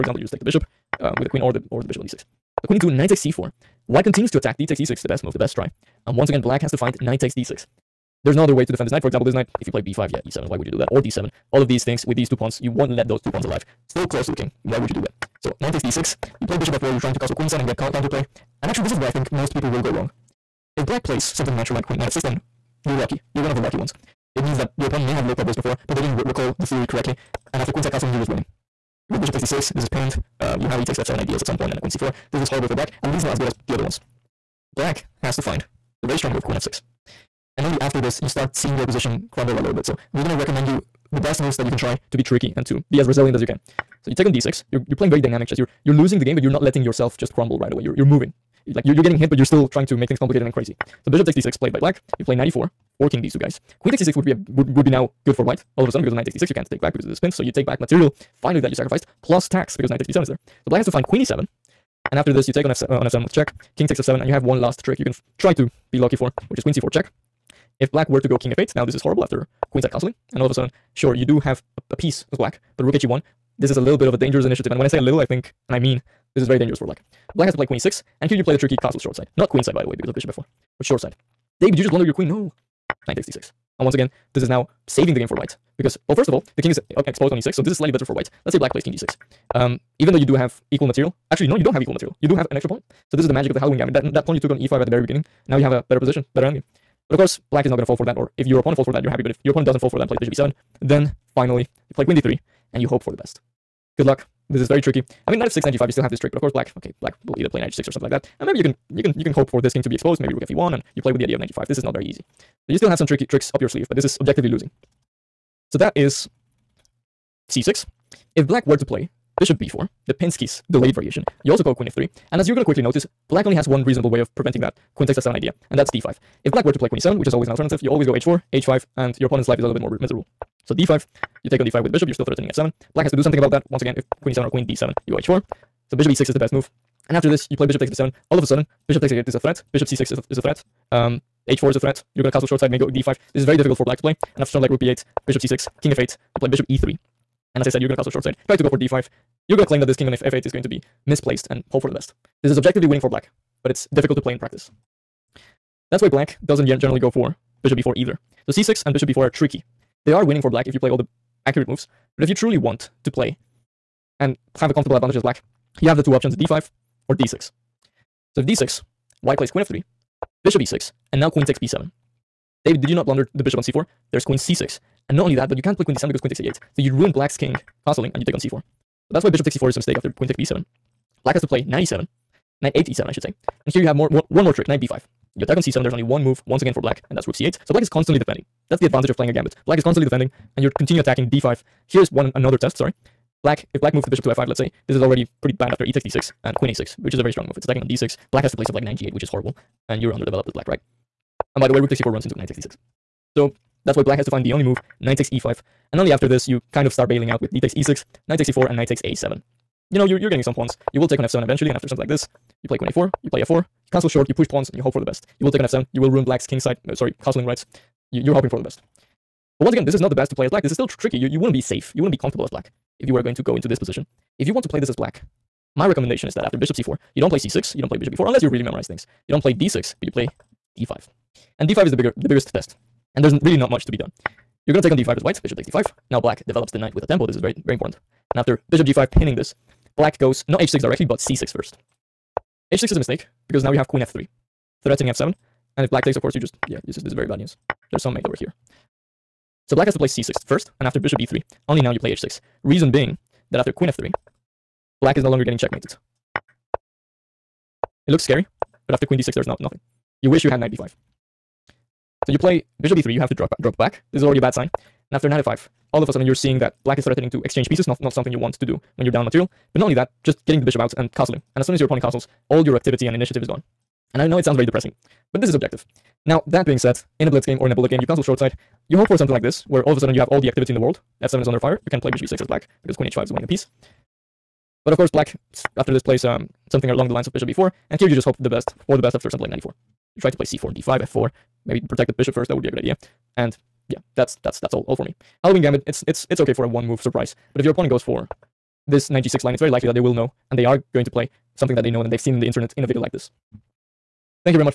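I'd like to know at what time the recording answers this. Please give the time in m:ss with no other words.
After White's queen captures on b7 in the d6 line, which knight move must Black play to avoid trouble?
3:02.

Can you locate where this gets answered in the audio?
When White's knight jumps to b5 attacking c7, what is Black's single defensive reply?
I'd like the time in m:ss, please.
3:07.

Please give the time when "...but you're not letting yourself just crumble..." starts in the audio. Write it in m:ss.
0:46.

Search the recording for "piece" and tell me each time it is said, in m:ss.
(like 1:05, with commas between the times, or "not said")
1:11, 4:27, 4:43.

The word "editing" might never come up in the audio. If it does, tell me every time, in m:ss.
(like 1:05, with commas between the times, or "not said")
not said.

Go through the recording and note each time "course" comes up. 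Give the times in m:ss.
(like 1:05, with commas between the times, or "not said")
1:37, 1:46, 4:06, 4:44.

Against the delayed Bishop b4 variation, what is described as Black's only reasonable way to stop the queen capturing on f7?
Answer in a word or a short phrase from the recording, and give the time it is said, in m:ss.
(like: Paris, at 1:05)
d5, at 2:05.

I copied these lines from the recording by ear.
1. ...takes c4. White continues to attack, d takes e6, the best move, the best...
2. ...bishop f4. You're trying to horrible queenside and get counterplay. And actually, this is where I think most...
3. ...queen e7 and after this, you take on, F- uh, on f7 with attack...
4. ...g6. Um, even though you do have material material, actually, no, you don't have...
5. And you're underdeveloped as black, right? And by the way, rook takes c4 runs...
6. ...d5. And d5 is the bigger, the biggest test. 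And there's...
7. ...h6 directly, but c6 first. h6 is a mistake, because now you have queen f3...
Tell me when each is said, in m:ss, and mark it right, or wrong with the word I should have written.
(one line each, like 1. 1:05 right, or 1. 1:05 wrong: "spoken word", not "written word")
1. 0:03 right
2. 0:16 wrong: "castle", not "horrible"
3. 1:01 wrong: "check", not "attack"
4. 1:28 wrong: "equal", not "material"
5. 3:19 right
6. 3:50 right
7. 4:00 right.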